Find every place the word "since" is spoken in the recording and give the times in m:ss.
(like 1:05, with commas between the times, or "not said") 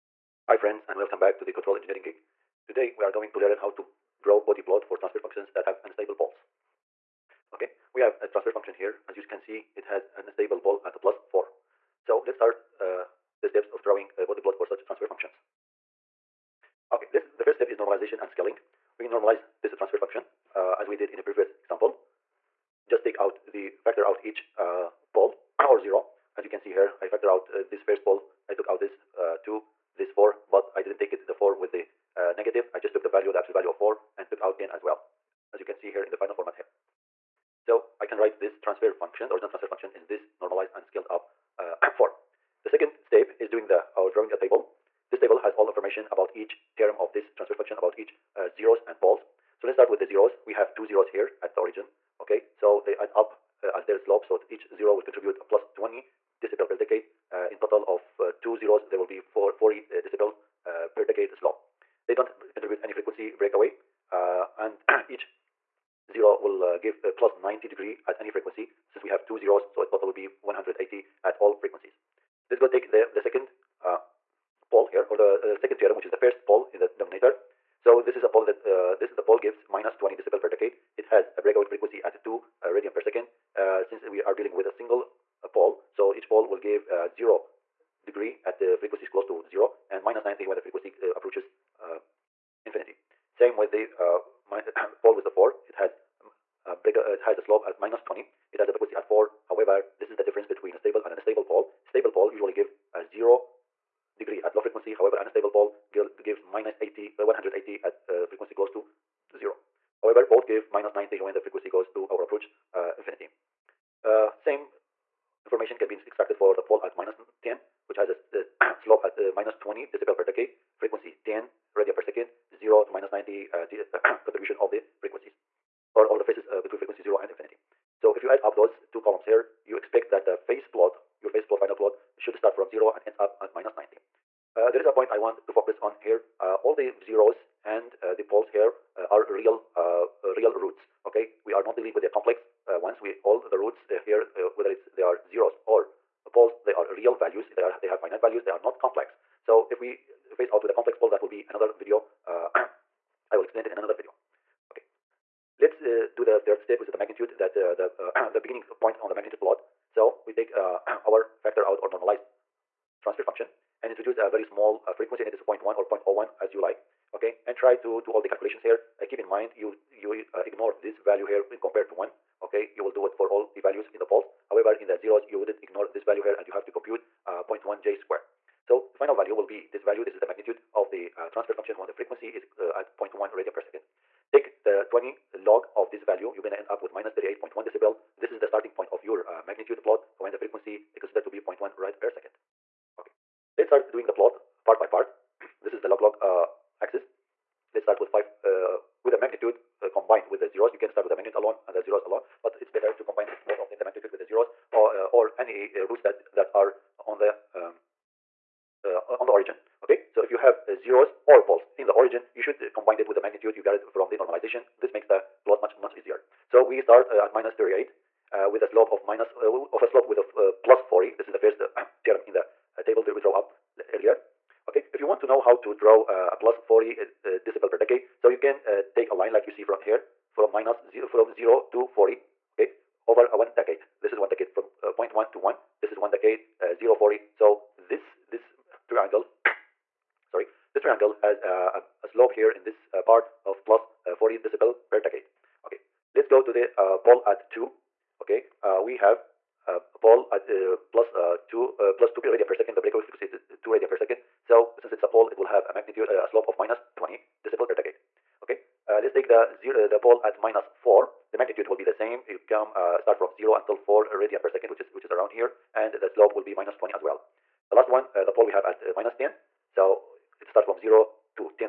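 1:08, 1:23, 4:14.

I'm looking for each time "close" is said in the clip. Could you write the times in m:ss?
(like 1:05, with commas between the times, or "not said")
1:29, 1:48.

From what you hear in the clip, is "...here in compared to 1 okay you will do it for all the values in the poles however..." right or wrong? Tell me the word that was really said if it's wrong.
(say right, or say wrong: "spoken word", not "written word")
right.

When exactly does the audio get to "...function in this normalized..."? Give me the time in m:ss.
0:39.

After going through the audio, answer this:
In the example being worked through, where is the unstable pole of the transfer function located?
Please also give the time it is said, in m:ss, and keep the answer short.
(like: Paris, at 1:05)
+4, at 0:10.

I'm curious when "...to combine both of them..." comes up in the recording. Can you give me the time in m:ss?
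3:22.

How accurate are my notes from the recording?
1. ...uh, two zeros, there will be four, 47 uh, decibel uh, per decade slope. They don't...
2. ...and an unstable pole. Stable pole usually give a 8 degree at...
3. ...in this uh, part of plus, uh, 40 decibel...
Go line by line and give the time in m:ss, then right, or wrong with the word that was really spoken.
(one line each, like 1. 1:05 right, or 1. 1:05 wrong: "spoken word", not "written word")
1. 0:58 wrong: "40", not "47"
2. 1:41 wrong: "0", not "8"
3. 4:02 right.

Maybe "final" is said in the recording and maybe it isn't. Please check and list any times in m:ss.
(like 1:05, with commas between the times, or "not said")
0:36, 2:11, 2:59.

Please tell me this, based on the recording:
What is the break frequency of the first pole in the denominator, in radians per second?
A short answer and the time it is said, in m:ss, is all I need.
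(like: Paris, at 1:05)
2, at 1:22.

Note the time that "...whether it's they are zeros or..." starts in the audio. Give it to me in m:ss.
2:24.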